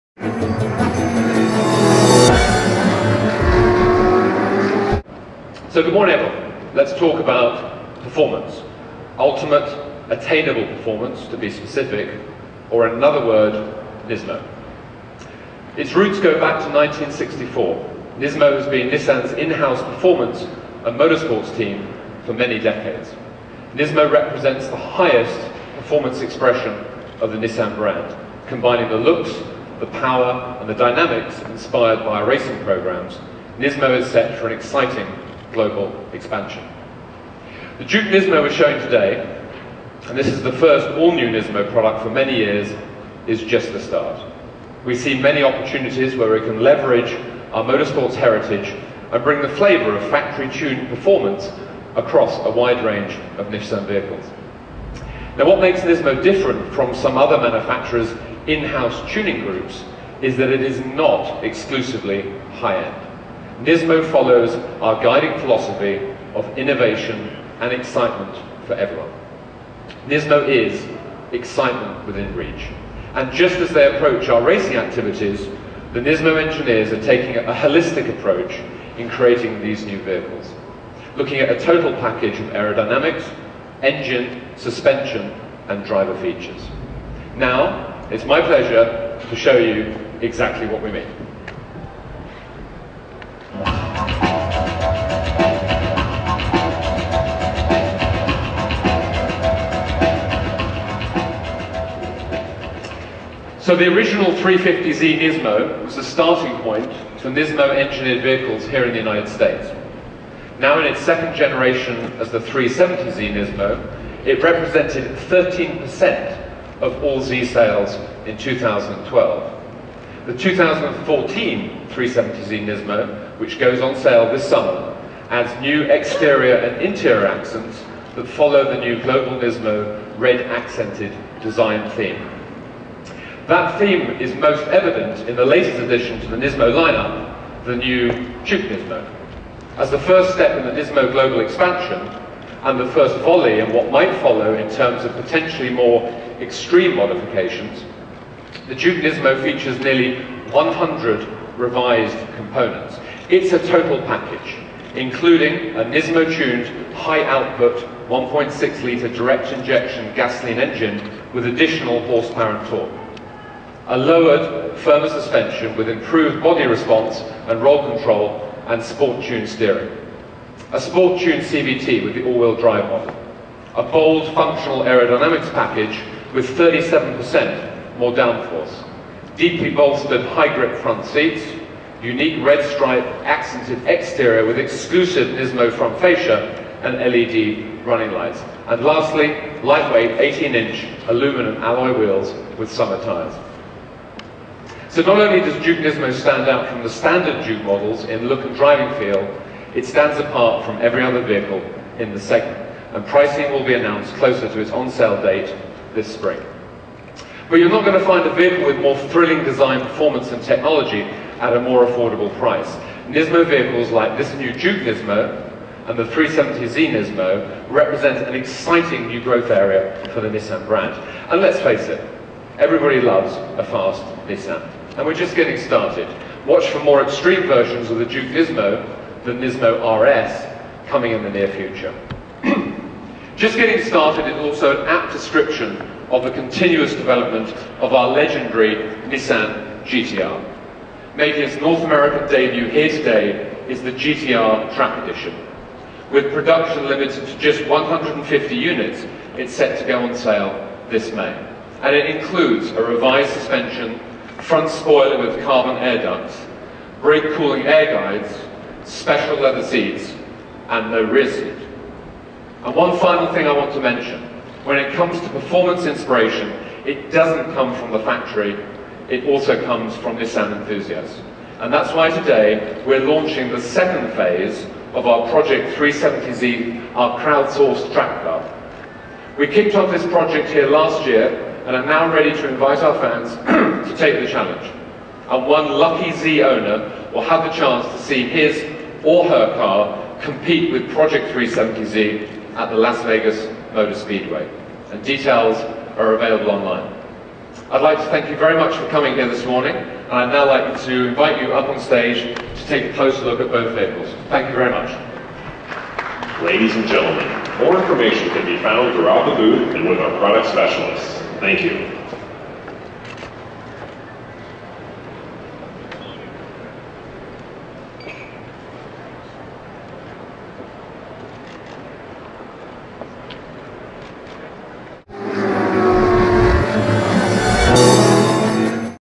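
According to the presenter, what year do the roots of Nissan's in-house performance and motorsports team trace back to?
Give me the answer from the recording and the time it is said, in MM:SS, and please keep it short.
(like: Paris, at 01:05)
1964, at 00:16.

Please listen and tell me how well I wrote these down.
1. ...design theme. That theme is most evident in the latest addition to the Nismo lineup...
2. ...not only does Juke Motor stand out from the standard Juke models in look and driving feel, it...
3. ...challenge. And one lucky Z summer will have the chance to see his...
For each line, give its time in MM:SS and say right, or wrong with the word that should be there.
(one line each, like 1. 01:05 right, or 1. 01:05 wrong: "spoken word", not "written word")
1. 02:11 right
2. 03:15 wrong: "Nismo", not "Motor"
3. 04:44 wrong: "owner", not "summer".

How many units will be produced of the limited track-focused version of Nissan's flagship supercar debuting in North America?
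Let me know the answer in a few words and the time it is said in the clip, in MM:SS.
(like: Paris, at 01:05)
150, at 04:07.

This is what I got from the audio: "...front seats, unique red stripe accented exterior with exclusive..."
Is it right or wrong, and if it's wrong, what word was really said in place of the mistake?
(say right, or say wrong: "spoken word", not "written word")
right.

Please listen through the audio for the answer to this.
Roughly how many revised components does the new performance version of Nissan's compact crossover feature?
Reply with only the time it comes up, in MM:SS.
02:29.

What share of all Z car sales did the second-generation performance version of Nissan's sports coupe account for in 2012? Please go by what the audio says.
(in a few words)
13%.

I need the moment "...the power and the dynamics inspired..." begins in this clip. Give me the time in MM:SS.
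00:29.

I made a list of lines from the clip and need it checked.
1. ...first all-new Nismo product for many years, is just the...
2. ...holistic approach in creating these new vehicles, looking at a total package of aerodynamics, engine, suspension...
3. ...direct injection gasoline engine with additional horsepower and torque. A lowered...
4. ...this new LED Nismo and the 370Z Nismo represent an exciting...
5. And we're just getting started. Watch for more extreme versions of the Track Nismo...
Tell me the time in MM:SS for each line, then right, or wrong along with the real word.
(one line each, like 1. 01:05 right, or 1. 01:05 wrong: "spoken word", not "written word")
1. 00:40 right
2. 01:17 right
3. 02:39 right
4. 03:34 wrong: "Juke", not "LED"
5. 03:44 wrong: "Juke", not "Track".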